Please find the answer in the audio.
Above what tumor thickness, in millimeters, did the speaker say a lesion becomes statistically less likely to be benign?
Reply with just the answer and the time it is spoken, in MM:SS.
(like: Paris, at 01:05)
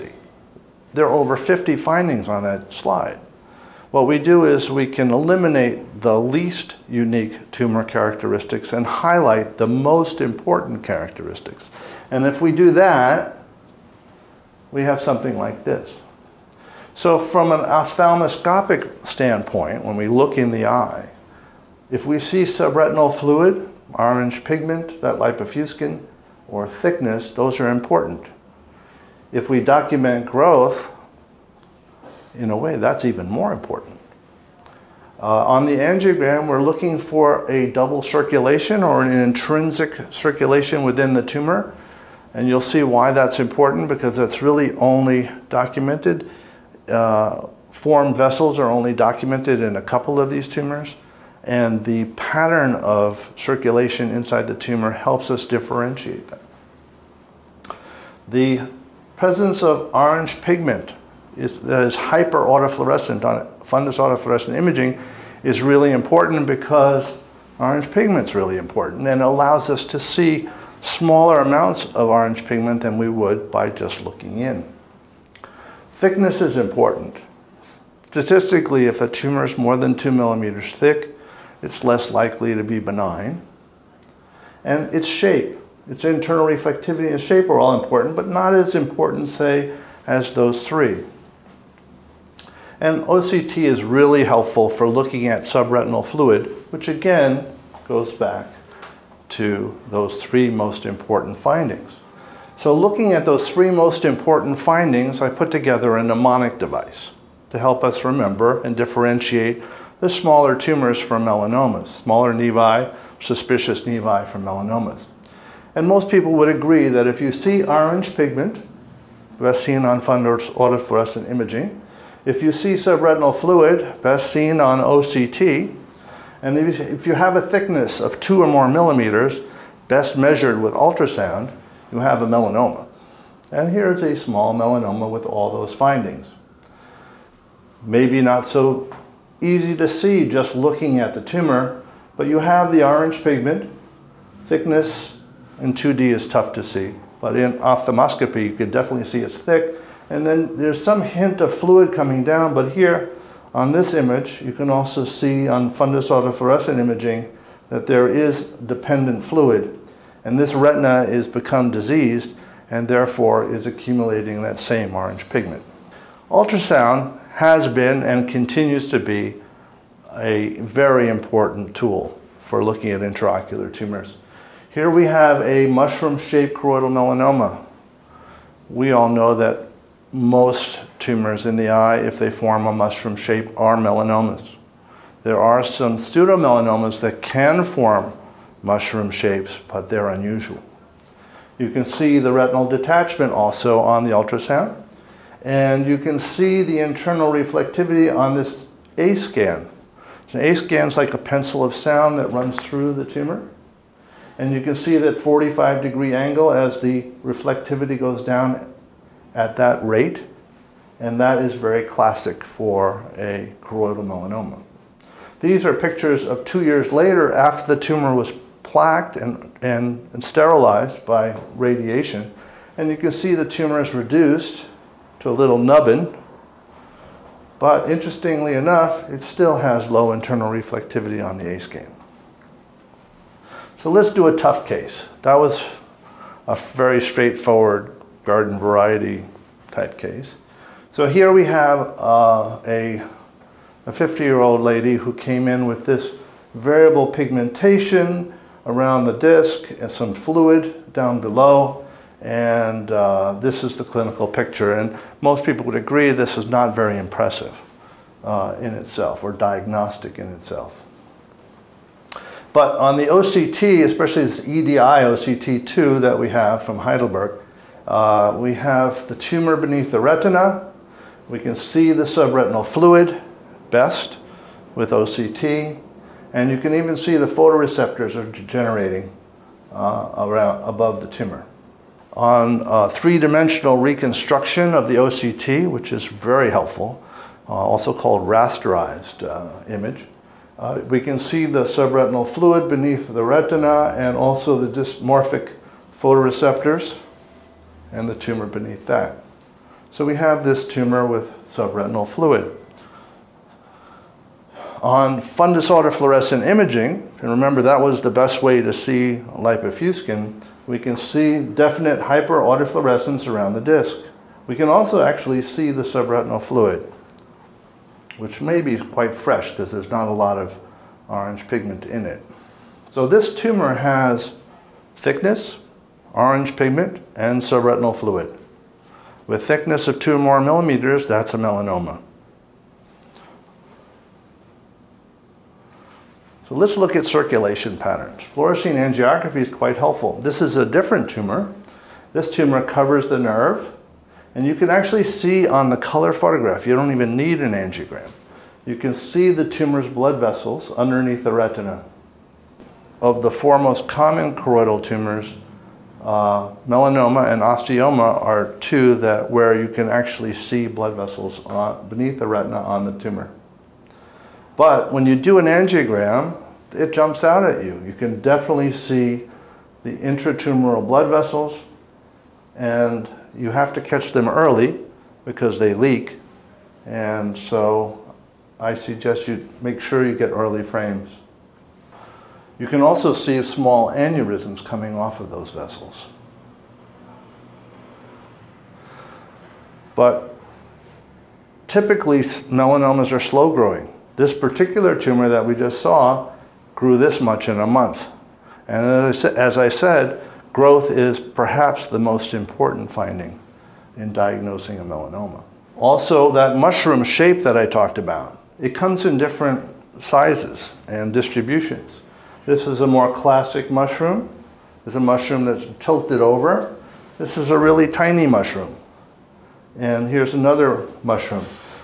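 2 millimeters, at 01:19.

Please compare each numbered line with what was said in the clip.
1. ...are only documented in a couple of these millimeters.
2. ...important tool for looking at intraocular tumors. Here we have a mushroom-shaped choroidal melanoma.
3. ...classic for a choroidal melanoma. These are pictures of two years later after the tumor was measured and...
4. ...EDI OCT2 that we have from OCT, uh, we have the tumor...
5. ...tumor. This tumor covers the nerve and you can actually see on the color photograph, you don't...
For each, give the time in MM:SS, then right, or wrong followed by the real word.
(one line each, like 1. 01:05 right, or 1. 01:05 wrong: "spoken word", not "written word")
1. 00:48 wrong: "tumors", not "millimeters"
2. 02:51 right
3. 03:31 wrong: "plaqued", not "measured"
4. 04:24 wrong: "Heidelberg", not "OCT"
5. 05:41 right.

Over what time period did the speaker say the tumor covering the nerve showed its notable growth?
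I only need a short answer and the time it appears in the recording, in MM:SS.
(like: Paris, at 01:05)
a month, at 06:37.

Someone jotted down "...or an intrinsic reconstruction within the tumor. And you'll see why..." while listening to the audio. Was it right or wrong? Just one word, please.
wrong.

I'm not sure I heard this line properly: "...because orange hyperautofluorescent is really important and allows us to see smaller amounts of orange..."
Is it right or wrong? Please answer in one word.
wrong.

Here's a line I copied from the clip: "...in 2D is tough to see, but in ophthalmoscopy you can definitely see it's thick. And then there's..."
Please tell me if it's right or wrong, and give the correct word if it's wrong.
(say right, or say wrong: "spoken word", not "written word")
right.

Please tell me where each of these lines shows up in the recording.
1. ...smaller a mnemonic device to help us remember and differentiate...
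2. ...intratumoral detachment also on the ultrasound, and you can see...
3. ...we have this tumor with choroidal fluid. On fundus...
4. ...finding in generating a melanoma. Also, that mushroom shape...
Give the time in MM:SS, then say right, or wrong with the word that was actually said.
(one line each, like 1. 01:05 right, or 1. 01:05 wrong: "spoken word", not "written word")
1. 01:45 wrong: "together", not "smaller"
2. 03:12 wrong: "retinal", not "intratumoral"
3. 05:00 wrong: "subretinal", not "choroidal"
4. 06:42 wrong: "diagnosing", not "generating".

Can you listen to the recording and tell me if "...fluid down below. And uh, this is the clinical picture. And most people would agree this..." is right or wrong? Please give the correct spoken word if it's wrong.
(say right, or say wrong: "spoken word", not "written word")
right.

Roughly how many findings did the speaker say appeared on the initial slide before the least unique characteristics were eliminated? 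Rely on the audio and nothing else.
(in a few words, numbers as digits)
over 50.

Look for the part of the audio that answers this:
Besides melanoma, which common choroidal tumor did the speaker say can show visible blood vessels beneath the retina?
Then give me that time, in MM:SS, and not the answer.
05:57.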